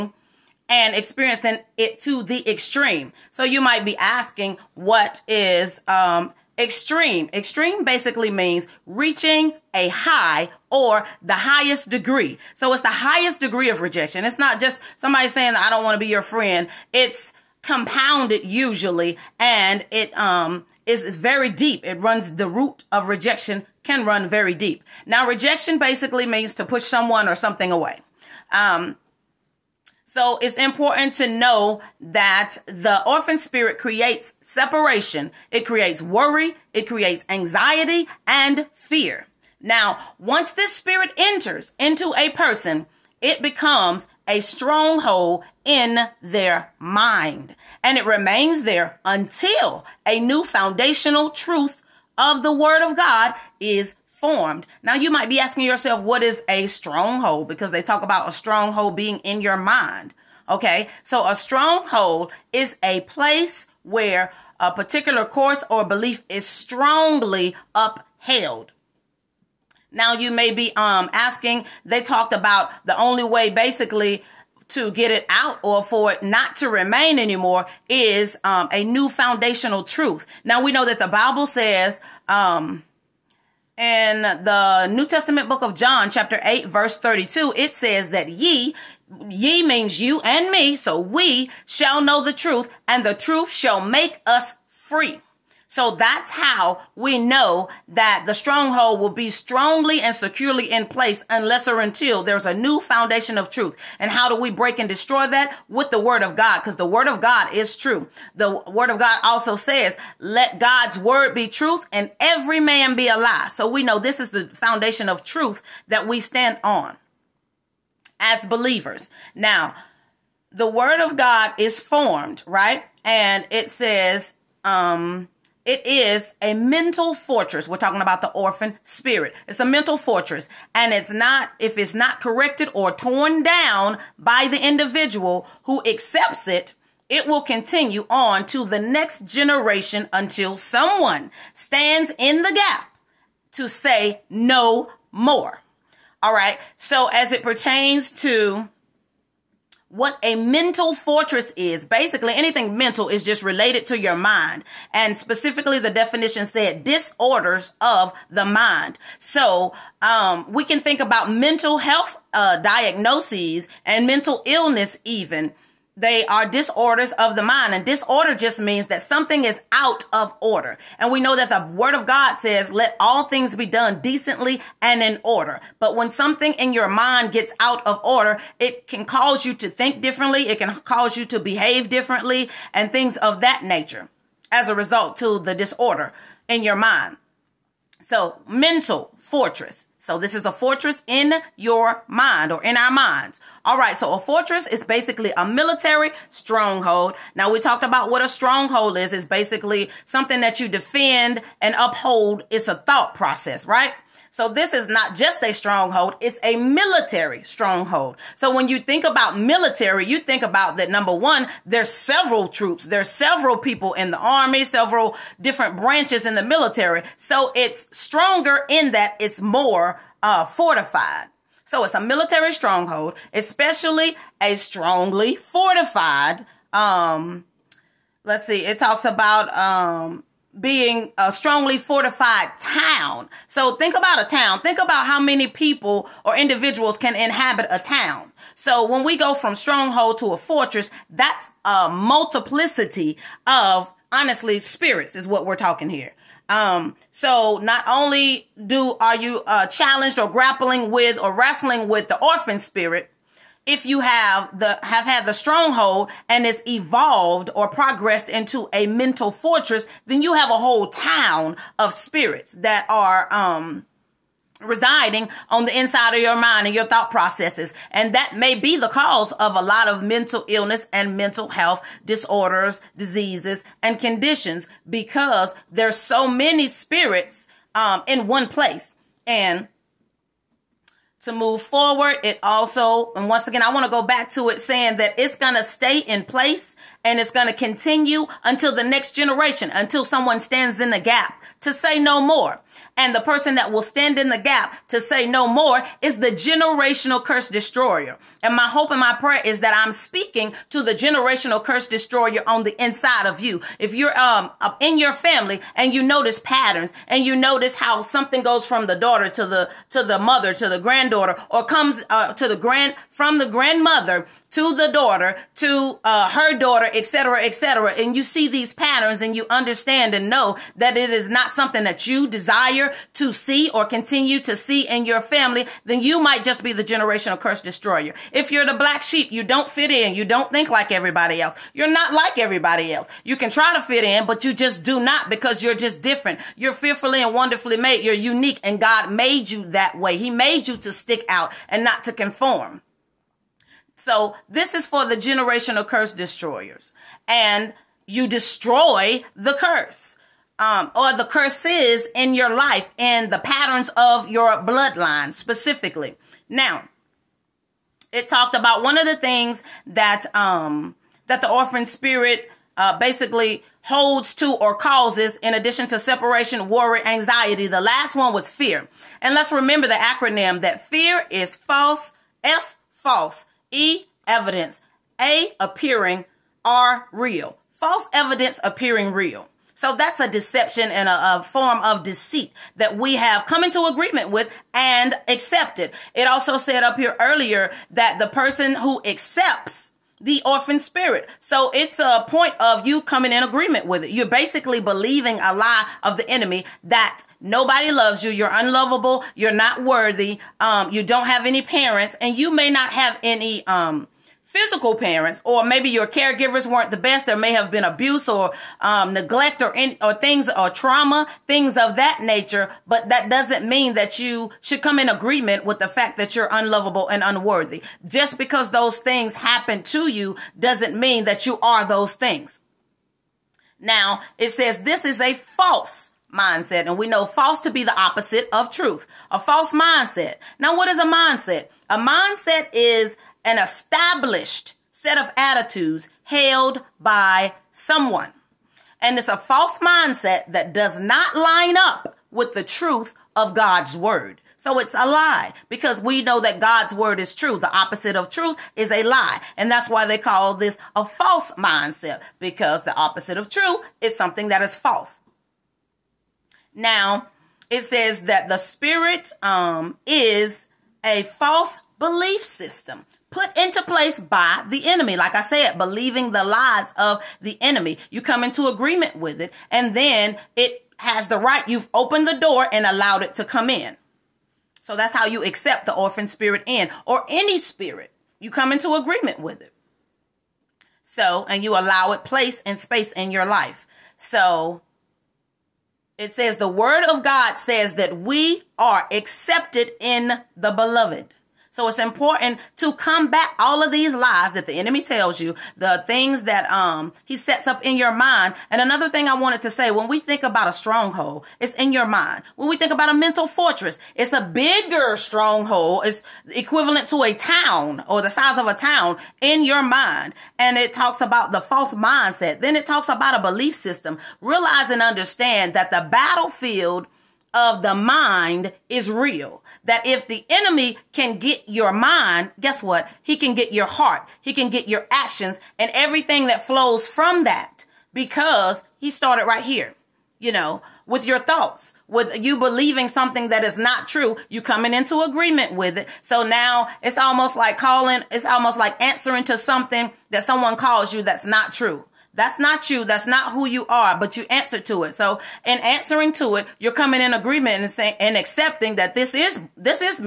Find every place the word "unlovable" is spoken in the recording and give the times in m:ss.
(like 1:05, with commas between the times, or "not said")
6:38, 6:56.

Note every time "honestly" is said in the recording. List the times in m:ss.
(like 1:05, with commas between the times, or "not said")
4:04.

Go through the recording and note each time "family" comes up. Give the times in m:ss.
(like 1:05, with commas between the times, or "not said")
5:05, 5:25.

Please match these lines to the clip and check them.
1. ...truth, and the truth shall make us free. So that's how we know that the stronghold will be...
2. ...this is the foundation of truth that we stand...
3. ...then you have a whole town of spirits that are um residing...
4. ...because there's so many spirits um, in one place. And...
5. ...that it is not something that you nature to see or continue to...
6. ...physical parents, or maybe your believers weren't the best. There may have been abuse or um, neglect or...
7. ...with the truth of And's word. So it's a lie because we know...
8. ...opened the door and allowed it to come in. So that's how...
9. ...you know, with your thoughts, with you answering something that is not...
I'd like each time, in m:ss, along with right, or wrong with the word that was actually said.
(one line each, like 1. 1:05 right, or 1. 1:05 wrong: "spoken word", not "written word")
1. 1:32 right
2. 1:53 right
3. 4:20 right
4. 4:34 right
5. 5:20 wrong: "desire", not "nature"
6. 6:44 wrong: "caregivers", not "believers"
7. 7:22 wrong: "God", not "And"
8. 7:51 right
9. 8:50 wrong: "believing", not "answering".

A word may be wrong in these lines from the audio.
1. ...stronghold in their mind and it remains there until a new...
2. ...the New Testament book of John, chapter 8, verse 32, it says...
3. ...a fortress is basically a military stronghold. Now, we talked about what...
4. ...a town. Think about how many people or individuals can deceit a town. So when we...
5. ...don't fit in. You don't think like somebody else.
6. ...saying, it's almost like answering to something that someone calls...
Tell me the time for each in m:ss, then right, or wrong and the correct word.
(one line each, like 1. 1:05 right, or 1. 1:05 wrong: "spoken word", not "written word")
1. 0:44 right
2. 1:24 right
3. 3:14 right
4. 3:54 wrong: "inhabit", not "deceit"
5. 5:29 wrong: "everybody", not "somebody"
6. 8:57 wrong: "calling", not "saying".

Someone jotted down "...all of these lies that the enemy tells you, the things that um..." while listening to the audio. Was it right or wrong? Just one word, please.
right.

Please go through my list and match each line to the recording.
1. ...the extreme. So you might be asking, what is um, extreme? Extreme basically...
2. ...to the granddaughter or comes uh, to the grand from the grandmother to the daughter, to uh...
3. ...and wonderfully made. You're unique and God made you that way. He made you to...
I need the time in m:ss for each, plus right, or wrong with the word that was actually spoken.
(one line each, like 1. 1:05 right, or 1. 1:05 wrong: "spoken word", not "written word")
1. 0:02 right
2. 5:10 right
3. 5:37 right.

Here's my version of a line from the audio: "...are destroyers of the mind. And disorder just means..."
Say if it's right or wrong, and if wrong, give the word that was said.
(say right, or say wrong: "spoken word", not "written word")
wrong: "disorders", not "destroyers".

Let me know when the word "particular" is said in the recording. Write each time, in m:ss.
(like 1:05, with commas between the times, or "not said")
1:04.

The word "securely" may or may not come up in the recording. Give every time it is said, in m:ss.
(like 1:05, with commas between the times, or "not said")
1:40.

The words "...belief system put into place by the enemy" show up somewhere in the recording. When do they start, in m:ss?
7:41.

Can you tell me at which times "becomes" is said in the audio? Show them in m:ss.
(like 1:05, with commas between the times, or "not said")
0:43.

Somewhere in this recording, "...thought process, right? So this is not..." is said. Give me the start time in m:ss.
3:22.